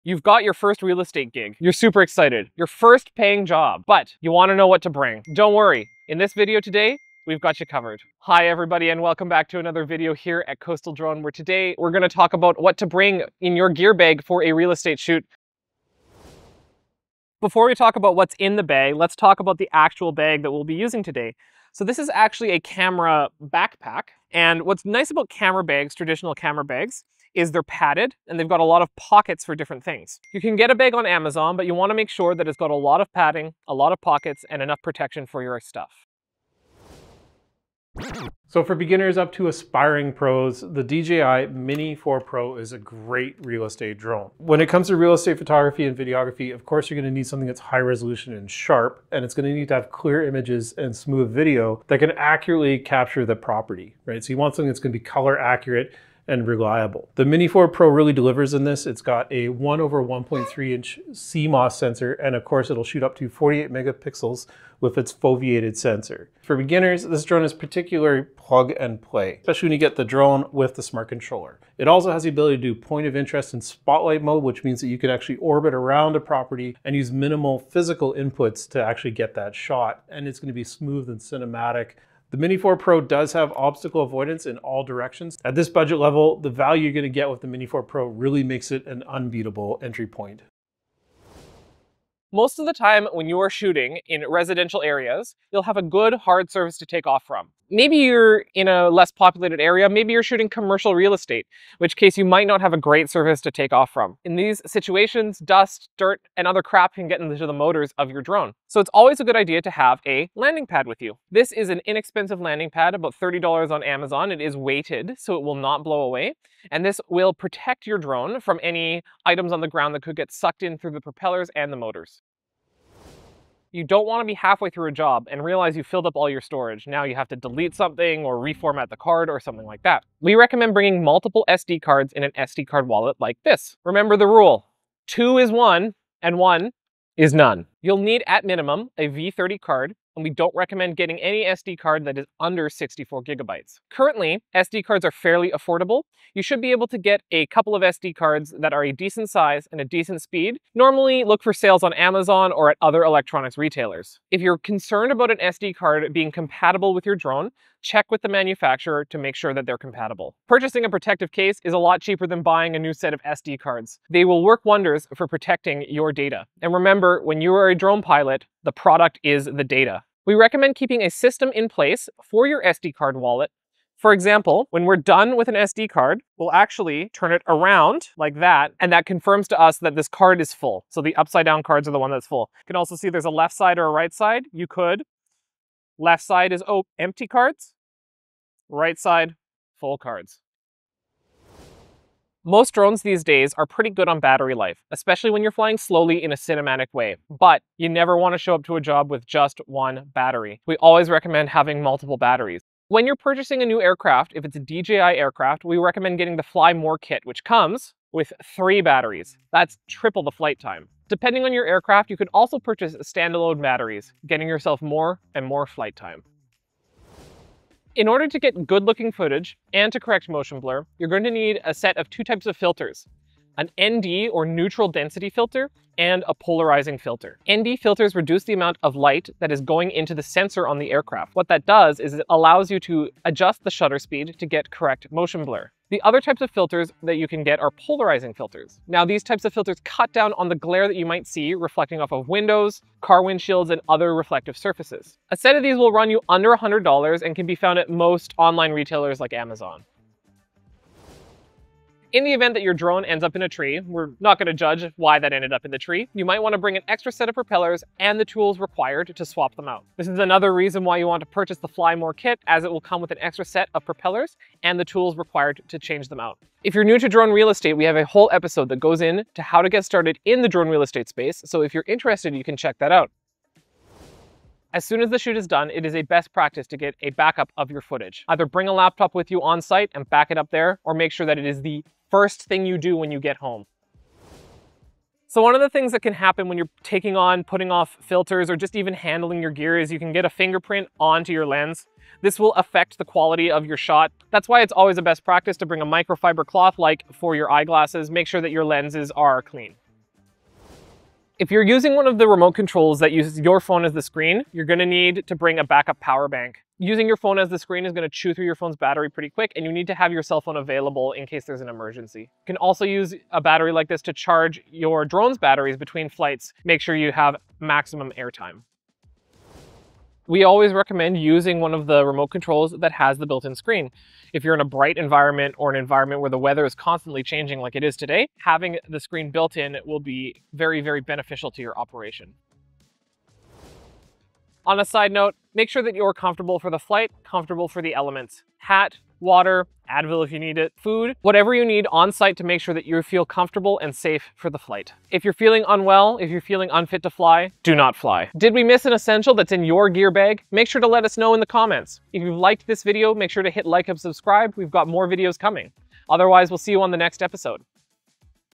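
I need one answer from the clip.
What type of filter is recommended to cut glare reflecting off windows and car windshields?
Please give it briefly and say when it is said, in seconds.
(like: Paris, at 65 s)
Polarizing filter, at 237 s.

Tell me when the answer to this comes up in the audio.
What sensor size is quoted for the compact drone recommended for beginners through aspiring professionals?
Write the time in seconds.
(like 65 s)
59 s.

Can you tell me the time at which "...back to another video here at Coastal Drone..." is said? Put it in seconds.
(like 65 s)
9 s.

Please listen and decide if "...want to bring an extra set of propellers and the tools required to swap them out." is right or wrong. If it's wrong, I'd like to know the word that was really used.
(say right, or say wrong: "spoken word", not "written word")
right.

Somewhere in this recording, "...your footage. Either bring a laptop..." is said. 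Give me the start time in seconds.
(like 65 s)
277 s.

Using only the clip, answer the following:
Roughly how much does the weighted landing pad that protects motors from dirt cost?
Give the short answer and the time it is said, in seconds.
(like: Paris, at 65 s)
$30, at 112 s.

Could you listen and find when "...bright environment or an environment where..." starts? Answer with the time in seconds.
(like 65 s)
324 s.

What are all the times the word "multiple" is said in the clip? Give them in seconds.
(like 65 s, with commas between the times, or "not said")
131 s, 201 s.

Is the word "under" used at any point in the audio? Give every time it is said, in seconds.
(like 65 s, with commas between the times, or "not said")
142 s, 246 s.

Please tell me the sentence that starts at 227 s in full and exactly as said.
ND filters reduce the amount of light that is going into the sensor on the aircraft.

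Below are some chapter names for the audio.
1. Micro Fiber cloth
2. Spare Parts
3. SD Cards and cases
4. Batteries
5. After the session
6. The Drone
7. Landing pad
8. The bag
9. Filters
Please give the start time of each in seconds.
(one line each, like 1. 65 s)
1. 283 s
2. 249 s
3. 122 s
4. 190 s
5. 273 s
6. 35 s
7. 90 s
8. 15 s
9. 216 s.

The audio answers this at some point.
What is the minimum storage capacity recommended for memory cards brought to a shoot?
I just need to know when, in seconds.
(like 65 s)
142 s.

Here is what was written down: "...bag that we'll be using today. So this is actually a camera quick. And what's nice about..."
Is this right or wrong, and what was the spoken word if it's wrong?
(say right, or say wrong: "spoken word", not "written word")
wrong: "backpack", not "quick".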